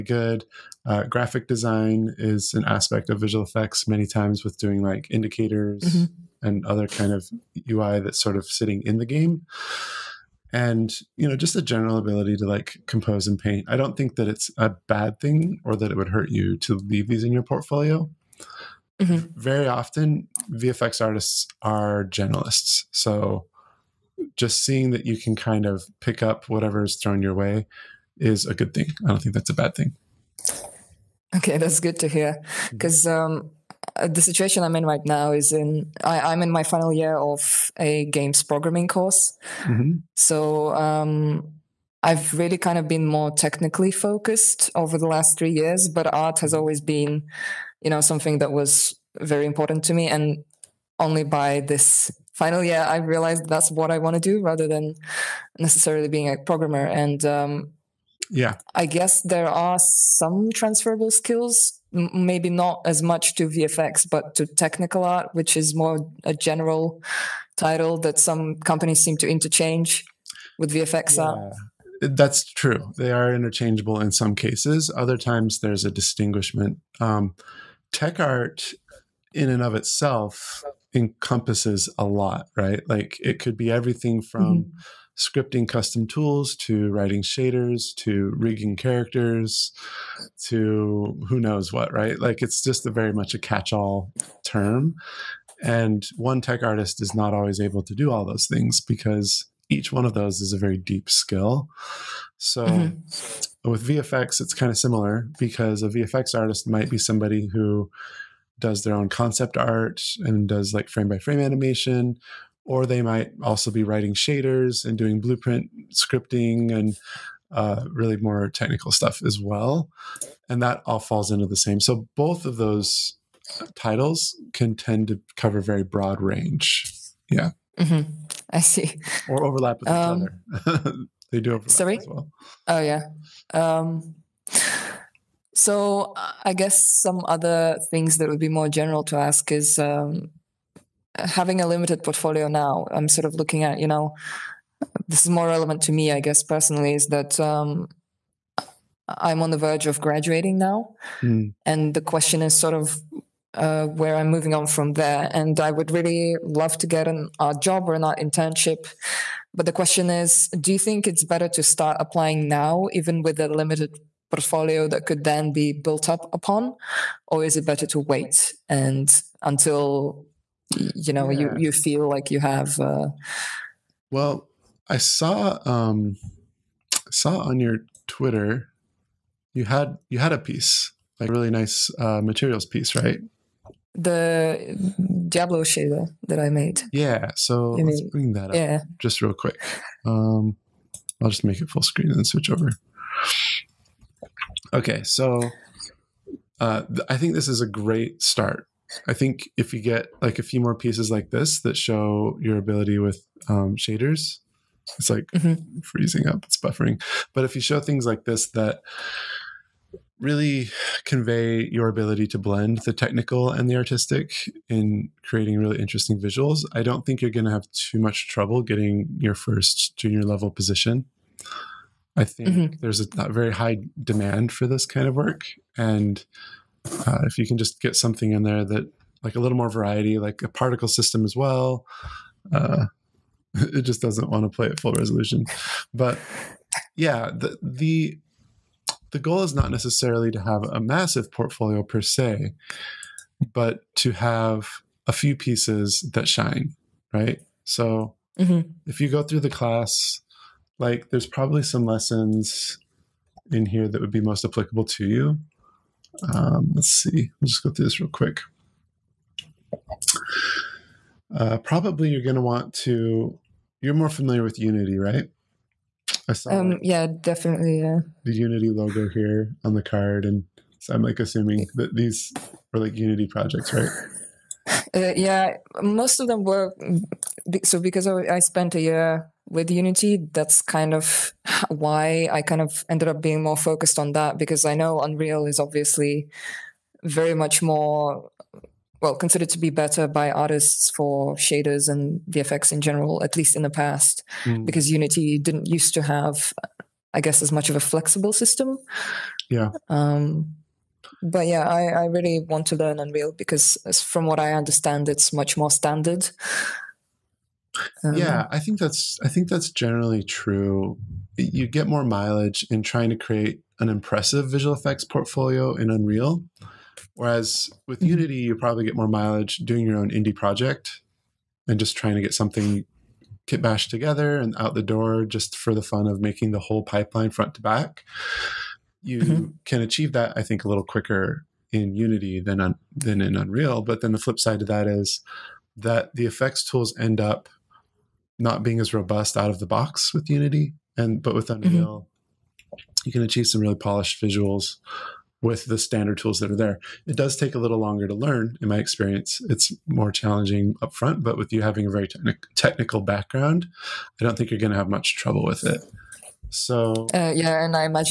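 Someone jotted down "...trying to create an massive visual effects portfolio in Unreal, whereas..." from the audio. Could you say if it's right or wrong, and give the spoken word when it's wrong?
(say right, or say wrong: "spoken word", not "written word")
wrong: "impressive", not "massive".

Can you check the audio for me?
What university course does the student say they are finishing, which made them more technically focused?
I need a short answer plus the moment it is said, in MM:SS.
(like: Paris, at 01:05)
Games programming, at 00:38.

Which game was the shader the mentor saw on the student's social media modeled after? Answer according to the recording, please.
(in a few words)
Diablo.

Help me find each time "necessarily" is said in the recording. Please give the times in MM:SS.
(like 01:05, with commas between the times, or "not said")
00:55, 03:59.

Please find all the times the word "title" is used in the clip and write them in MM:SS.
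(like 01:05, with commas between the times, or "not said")
01:07, 02:03.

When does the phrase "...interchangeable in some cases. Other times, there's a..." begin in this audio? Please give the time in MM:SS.
01:13.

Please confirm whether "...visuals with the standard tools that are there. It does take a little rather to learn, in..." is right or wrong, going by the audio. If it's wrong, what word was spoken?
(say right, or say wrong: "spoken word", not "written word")
wrong: "longer", not "rather".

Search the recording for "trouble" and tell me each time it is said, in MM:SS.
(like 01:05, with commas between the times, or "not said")
03:38, 05:55.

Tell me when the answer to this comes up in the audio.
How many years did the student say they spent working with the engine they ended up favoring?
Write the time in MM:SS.
04:38.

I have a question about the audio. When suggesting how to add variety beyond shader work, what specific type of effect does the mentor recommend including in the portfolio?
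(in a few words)
A particle system.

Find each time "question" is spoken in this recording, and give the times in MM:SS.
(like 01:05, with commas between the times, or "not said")
02:32, 02:39.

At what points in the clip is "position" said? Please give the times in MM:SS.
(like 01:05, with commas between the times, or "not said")
03:40.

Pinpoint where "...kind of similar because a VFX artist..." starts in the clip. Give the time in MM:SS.
01:44.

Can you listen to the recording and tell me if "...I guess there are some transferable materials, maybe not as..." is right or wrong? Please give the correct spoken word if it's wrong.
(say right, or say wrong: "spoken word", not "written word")
wrong: "skills", not "materials".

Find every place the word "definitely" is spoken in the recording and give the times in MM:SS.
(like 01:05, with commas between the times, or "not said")
04:27.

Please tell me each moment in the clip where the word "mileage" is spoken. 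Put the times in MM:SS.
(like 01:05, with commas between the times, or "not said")
05:12, 05:19.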